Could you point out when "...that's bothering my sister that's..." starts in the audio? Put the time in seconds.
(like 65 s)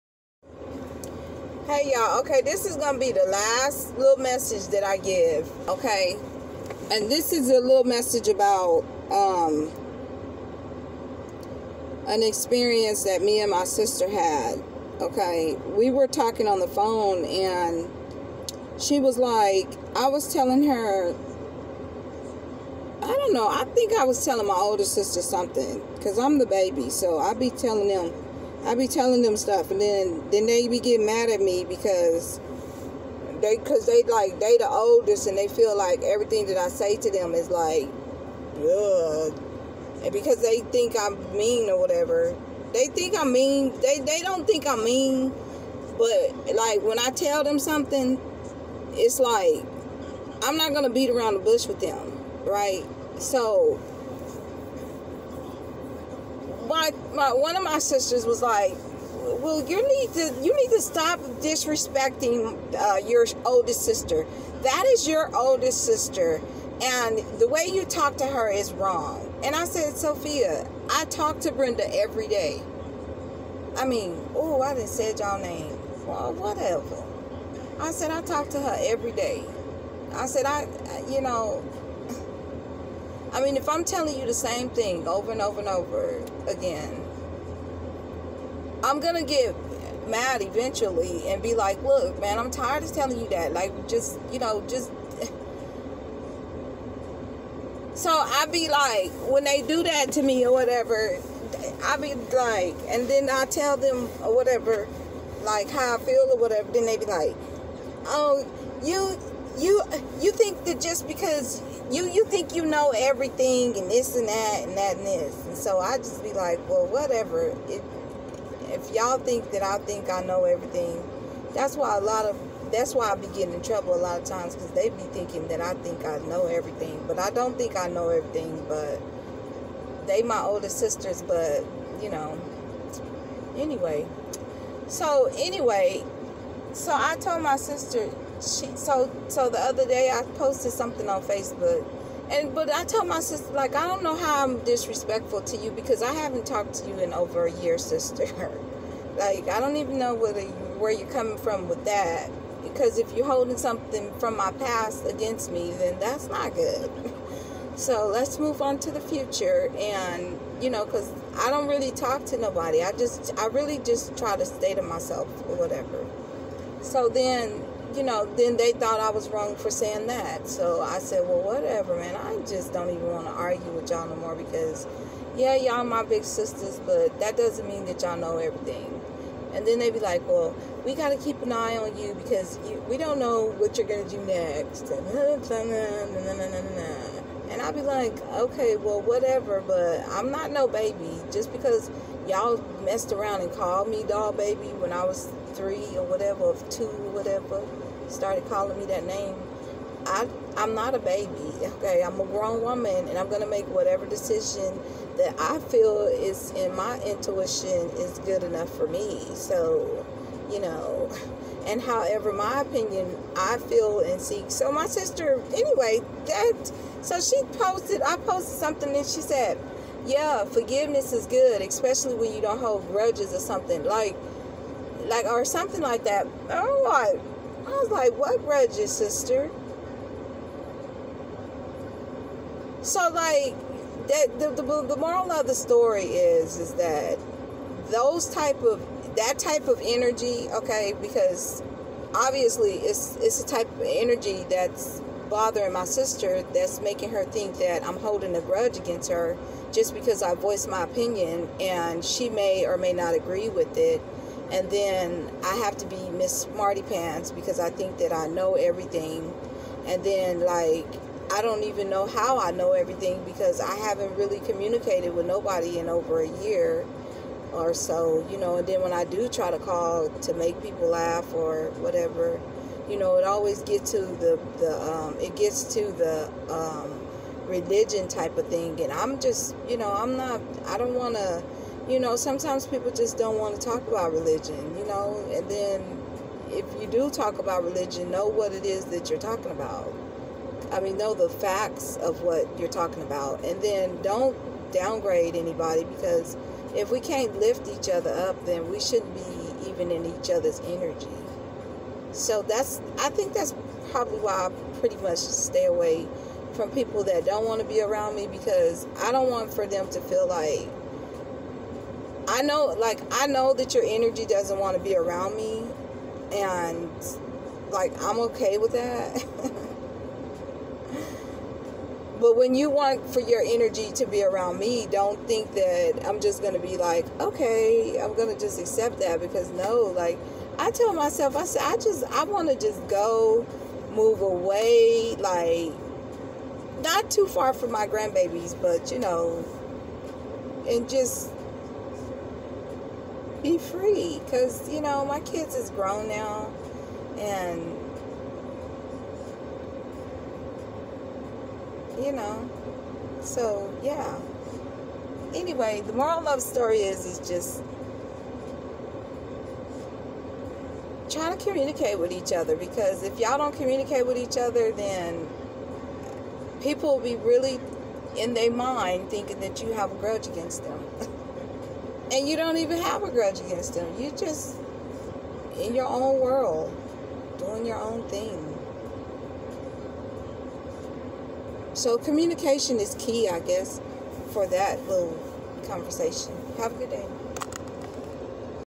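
244 s.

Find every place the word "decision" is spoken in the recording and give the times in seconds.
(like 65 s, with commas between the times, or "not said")
204 s.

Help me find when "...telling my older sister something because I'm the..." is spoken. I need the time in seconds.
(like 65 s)
24 s.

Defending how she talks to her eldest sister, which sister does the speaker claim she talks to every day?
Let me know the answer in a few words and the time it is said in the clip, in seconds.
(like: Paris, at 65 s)
Brenda, at 71 s.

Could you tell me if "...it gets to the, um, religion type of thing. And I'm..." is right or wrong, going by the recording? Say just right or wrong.
right.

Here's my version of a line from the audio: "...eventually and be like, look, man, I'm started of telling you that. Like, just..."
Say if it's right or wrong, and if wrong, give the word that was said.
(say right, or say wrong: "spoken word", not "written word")
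wrong: "tired", not "started".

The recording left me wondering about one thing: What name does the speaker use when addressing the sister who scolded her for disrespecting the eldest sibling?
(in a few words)
Sophia.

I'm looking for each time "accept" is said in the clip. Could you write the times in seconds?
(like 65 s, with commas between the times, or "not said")
328 s.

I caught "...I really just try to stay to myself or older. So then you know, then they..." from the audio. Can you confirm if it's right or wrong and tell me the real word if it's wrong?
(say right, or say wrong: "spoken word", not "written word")
wrong: "whatever", not "older".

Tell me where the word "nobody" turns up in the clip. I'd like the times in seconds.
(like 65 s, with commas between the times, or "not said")
162 s, 265 s.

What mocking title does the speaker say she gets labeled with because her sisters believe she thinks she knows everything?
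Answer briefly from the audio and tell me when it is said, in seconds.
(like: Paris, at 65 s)
Miss Smarty Pants, at 256 s.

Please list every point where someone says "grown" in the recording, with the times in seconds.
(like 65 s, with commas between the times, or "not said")
202 s, 345 s.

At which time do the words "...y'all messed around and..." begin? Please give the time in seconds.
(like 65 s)
192 s.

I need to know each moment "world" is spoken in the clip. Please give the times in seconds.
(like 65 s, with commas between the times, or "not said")
376 s.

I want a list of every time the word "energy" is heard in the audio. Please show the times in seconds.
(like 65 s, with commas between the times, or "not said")
239 s, 243 s, 300 s, 313 s, 323 s.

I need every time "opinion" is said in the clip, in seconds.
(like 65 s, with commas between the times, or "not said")
212 s, 250 s.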